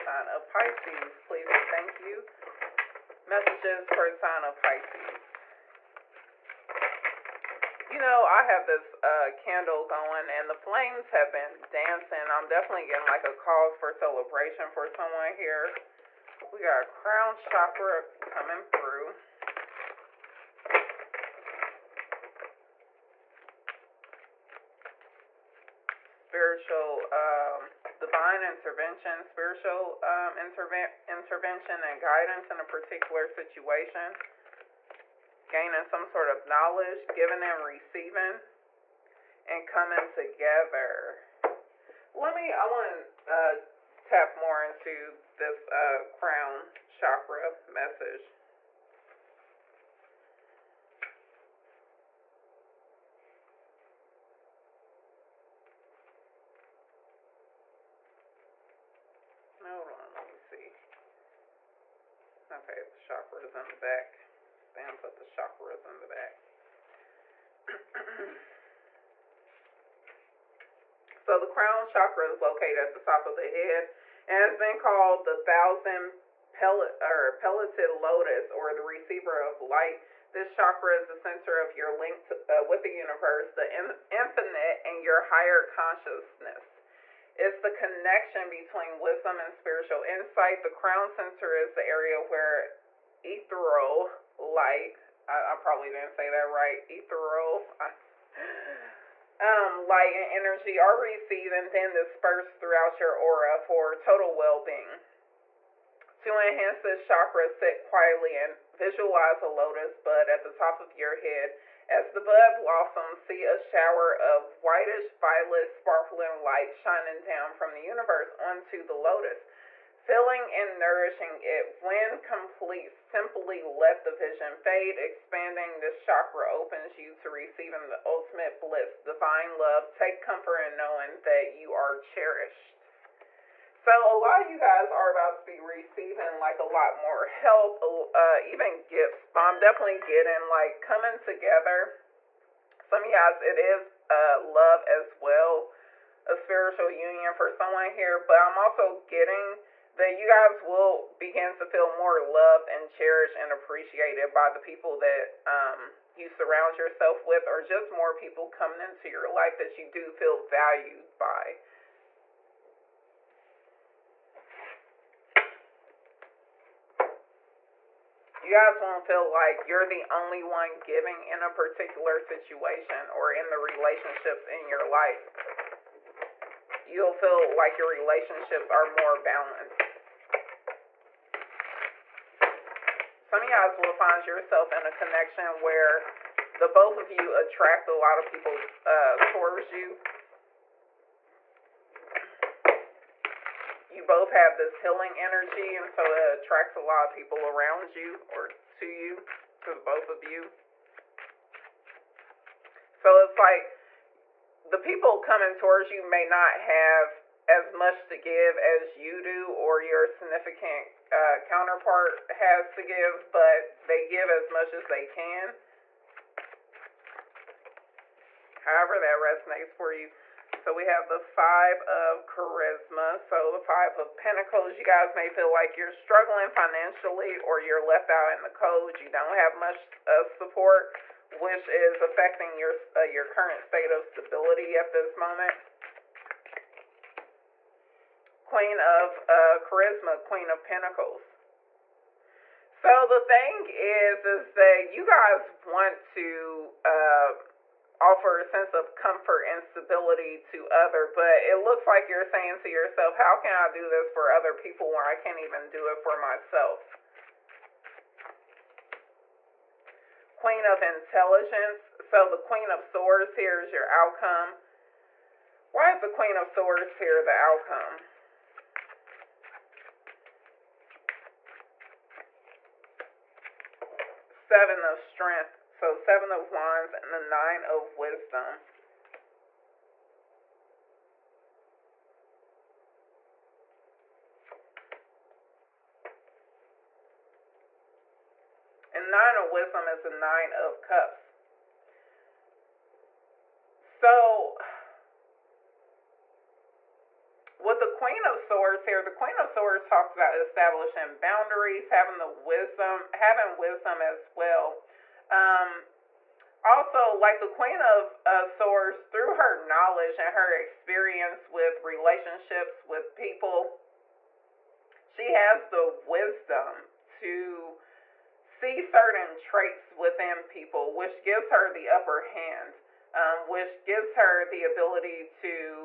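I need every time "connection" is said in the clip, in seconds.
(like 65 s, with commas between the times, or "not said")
87 s, 184 s.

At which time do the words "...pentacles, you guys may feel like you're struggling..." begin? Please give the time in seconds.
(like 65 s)
224 s.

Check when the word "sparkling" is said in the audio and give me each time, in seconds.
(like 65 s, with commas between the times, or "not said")
115 s.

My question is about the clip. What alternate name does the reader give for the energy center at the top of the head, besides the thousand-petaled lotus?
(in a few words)
receiver of light.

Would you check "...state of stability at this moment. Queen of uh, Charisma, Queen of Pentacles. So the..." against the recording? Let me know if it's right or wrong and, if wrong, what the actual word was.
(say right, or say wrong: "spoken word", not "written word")
right.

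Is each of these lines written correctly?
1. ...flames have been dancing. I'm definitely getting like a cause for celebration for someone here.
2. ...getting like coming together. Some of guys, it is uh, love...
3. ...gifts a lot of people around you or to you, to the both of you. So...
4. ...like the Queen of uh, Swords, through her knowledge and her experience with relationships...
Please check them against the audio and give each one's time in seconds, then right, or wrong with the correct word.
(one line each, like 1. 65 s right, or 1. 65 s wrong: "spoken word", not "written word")
1. 10 s right
2. 139 s right
3. 196 s wrong: "attracts", not "gifts"
4. 307 s right.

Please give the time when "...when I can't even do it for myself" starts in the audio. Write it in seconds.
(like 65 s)
254 s.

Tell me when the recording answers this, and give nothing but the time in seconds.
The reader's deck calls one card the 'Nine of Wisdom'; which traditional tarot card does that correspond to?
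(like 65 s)
290 s.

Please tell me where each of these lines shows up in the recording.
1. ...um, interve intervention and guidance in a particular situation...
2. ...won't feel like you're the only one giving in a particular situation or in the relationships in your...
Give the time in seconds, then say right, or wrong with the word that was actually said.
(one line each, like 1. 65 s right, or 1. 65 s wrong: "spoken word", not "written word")
1. 30 s right
2. 168 s right.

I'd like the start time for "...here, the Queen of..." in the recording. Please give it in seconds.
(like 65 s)
298 s.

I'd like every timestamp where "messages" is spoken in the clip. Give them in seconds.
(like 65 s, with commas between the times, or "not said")
3 s, 47 s.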